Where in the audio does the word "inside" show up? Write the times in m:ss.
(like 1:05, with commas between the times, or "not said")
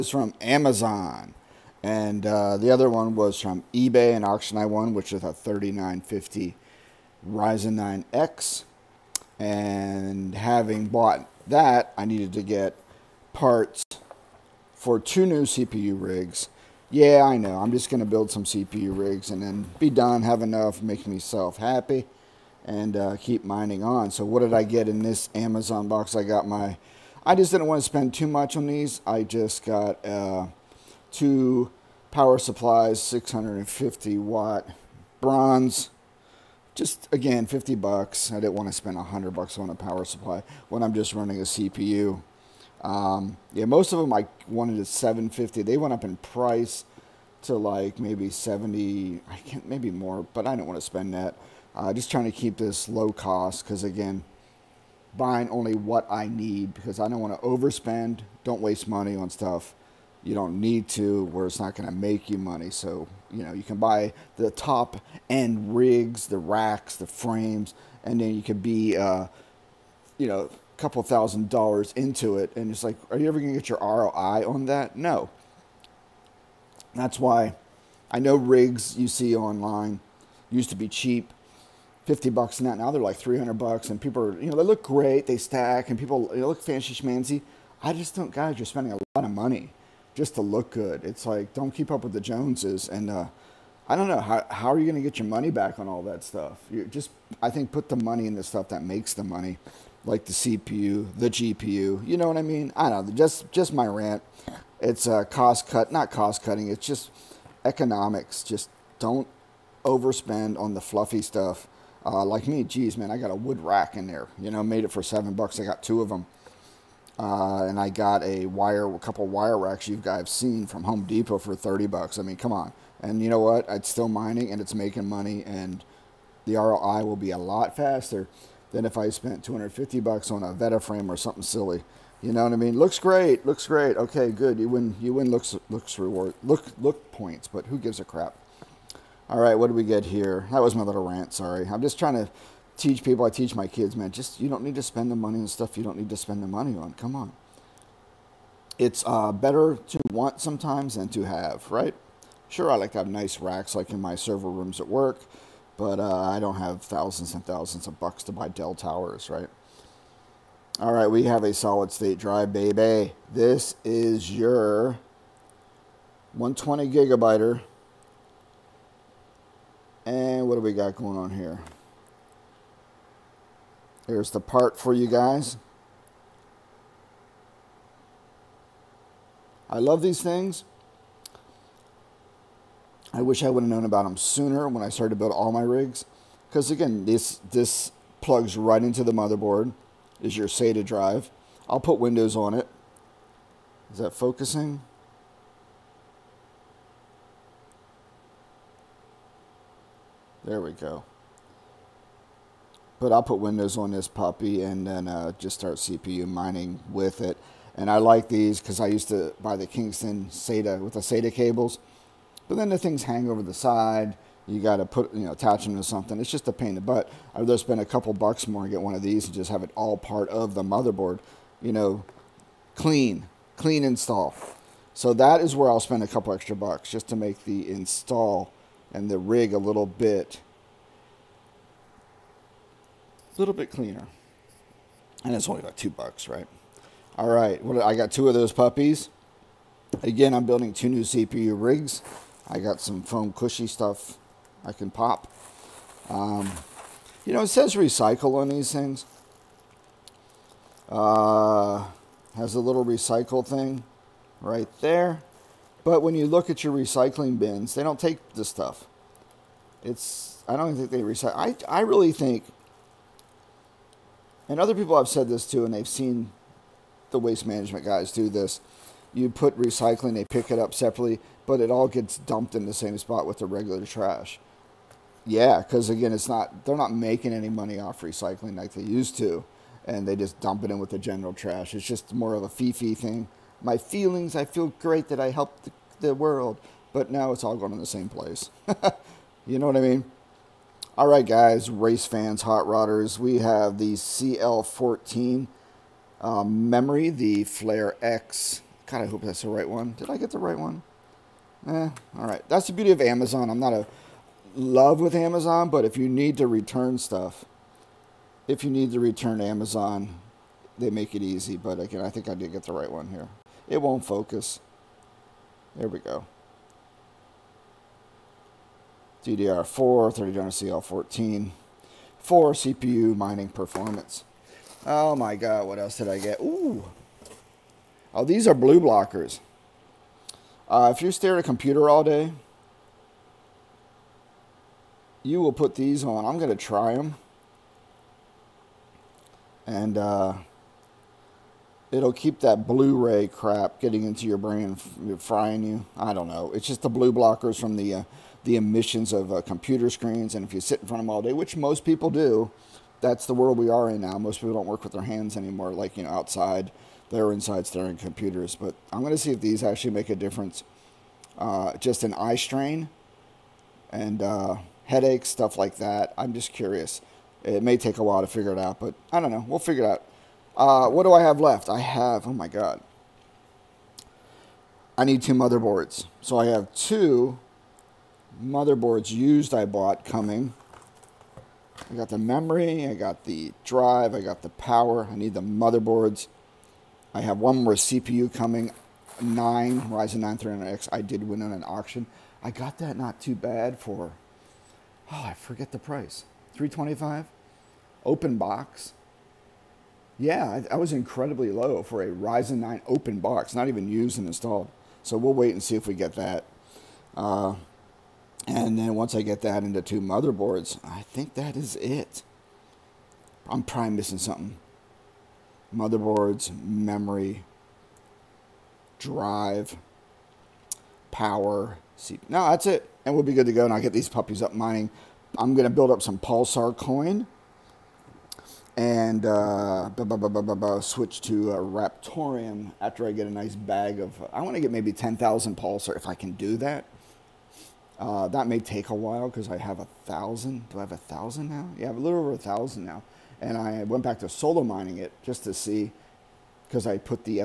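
5:57.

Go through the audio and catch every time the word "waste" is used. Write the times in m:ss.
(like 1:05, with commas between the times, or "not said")
0:58, 4:27.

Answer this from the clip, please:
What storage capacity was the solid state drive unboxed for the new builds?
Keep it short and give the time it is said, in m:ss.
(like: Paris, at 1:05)
120 gigabyte, at 2:46.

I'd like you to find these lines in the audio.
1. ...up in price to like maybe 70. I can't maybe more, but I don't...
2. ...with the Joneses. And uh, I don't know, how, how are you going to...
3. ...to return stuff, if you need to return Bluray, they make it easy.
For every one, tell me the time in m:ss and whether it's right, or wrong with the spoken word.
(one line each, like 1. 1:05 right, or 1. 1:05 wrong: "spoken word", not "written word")
1. 0:45 right
2. 1:32 right
3. 5:06 wrong: "Amazon", not "Bluray".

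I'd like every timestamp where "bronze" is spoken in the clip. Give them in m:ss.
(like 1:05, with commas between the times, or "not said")
0:35.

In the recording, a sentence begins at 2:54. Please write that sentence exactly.
Here's the part for you guys.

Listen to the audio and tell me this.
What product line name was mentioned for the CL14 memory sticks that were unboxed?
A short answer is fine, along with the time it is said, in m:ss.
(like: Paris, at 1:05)
Flare X, at 4:57.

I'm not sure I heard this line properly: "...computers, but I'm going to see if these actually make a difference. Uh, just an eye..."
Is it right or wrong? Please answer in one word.
right.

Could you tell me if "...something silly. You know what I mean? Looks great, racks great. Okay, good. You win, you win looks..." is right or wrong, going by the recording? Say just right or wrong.
wrong.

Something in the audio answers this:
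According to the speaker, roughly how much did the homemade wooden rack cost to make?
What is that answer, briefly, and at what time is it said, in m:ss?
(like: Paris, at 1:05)
7 dollars, at 1:55.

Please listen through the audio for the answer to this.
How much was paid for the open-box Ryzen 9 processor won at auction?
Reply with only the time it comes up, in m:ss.
6:36.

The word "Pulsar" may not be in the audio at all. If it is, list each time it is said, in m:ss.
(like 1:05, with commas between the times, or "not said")
7:06, 7:15.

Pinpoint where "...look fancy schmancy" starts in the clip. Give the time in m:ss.
1:26.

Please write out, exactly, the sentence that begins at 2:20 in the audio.
That was my little rant, sorry.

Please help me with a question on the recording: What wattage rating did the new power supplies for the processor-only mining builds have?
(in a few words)
650 watt.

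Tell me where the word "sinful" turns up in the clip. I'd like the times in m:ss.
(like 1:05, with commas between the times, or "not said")
not said.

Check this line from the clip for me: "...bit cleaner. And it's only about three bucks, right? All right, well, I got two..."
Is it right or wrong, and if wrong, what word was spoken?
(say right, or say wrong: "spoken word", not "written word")
wrong: "two", not "three".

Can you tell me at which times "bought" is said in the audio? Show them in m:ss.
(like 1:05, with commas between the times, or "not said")
0:10, 6:19.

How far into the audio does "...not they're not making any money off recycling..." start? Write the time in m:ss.
4:36.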